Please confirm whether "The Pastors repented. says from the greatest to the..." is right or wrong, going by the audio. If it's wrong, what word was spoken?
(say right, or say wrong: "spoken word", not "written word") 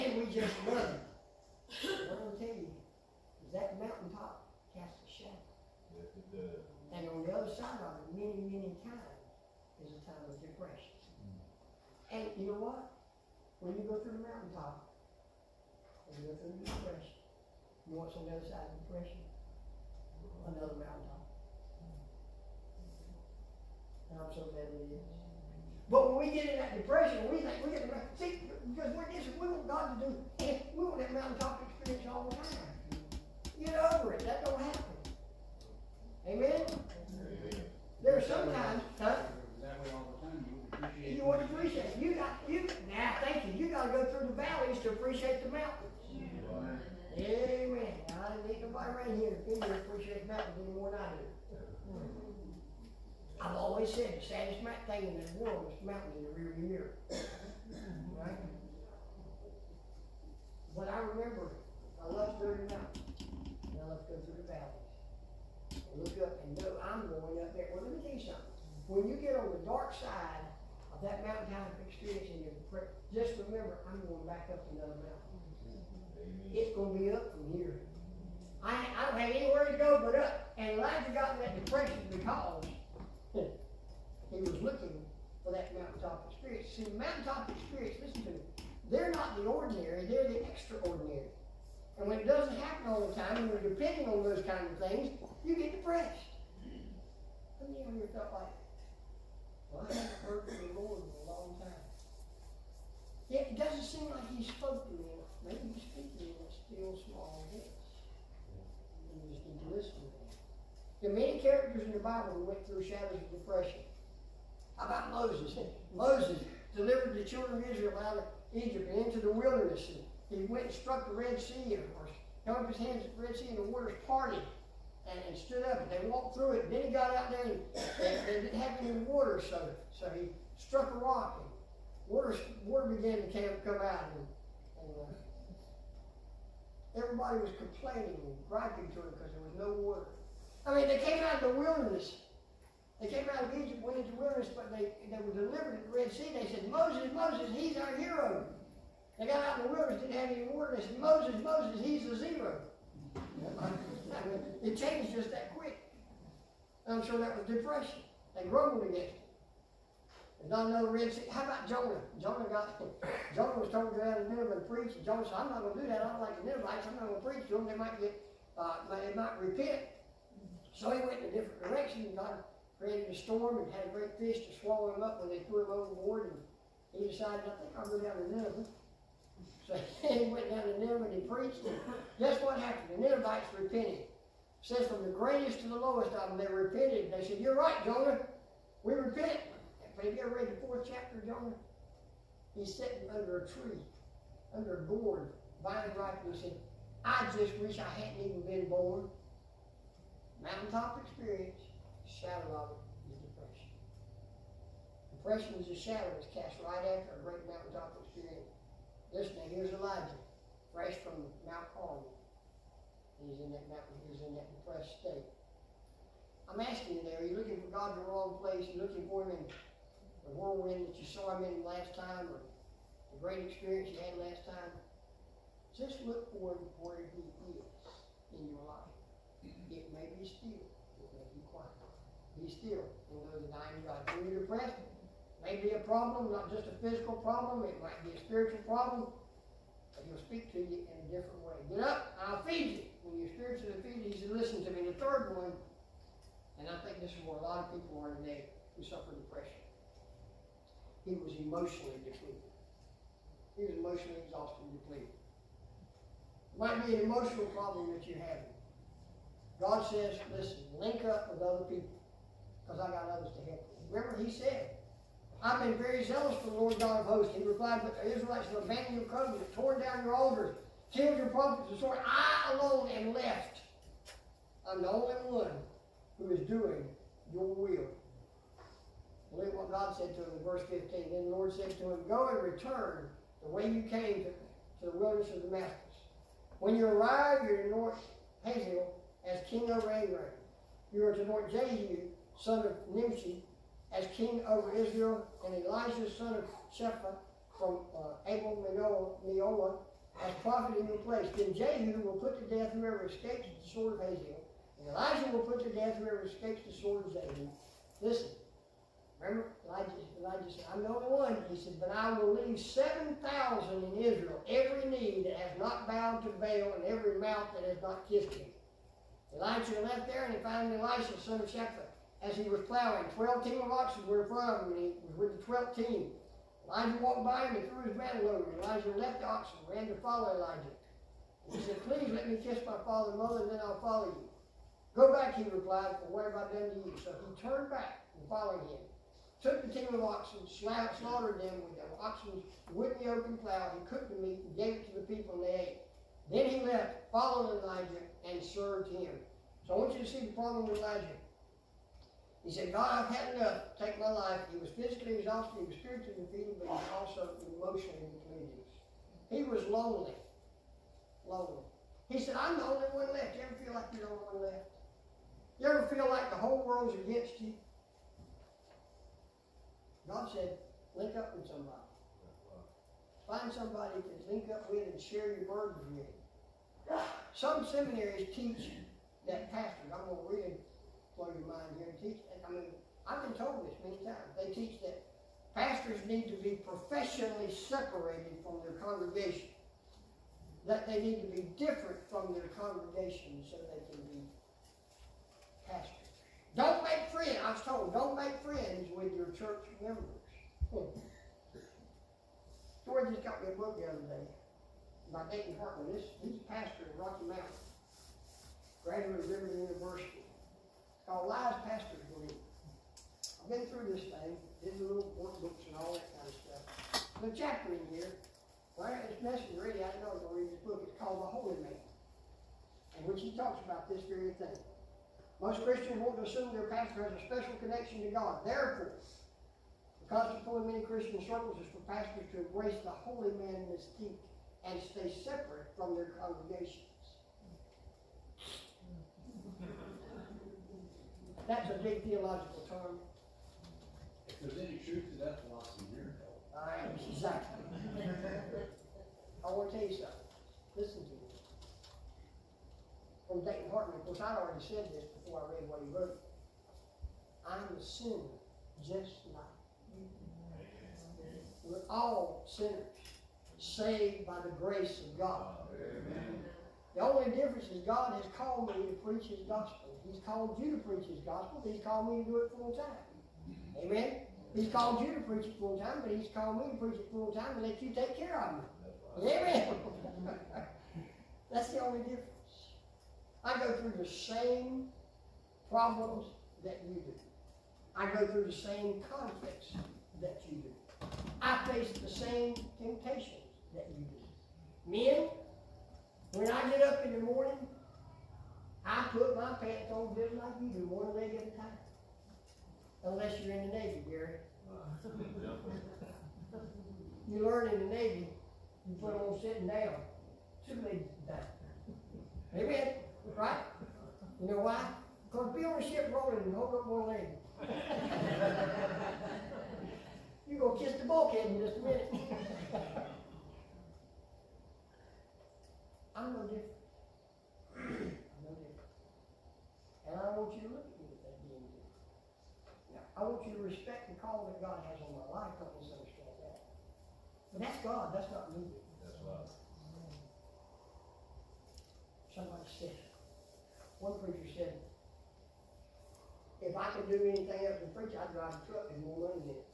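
wrong: "Ninevites", not "Pastors".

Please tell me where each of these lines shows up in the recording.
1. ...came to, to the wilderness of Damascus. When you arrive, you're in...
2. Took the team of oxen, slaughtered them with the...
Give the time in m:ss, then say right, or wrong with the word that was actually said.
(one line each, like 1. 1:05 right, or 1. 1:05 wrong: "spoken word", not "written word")
1. 4:43 right
2. 5:39 right.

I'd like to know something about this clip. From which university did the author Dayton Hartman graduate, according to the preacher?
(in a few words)
Liberty University.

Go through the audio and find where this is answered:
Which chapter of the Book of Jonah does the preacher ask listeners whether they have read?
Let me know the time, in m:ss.
3:10.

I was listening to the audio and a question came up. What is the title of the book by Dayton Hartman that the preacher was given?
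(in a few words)
Lies Pastors Believe.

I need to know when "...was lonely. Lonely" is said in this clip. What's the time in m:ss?
5:59.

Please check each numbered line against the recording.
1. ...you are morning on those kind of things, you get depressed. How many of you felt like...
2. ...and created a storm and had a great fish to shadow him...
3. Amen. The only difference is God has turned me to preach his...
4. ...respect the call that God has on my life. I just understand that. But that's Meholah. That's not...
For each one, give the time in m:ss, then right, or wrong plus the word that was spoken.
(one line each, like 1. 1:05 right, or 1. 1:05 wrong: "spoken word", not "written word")
1. 1:33 wrong: "depending", not "morning"
2. 2:52 wrong: "swallow", not "shadow"
3. 7:45 wrong: "called", not "turned"
4. 8:53 wrong: "God", not "Meholah".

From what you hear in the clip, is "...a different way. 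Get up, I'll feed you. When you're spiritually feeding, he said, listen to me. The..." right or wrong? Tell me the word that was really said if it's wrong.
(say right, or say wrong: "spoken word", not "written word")
right.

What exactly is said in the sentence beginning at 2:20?
I mean, they came out of the wilderness.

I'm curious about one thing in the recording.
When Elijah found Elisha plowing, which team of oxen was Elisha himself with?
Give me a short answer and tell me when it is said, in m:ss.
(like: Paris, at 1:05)
The 12th team, at 5:25.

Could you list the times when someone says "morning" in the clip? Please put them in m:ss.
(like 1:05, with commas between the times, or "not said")
8:17.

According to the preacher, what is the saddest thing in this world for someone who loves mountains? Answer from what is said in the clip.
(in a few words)
The mountain in the rearview mirror.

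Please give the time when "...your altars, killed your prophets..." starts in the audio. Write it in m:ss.
4:30.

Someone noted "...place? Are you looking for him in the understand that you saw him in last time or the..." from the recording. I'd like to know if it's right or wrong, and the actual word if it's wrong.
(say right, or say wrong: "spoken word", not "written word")
wrong: "whirlwind", not "understand".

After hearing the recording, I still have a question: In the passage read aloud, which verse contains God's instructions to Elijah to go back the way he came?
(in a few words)
Verse 15.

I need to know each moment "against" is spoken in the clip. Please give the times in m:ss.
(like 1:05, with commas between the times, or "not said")
2:38, 6:06.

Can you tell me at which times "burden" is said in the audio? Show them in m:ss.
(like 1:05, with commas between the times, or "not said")
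6:15.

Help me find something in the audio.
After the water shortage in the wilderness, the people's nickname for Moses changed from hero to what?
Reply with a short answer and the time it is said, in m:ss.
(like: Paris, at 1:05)
Zero, at 2:32.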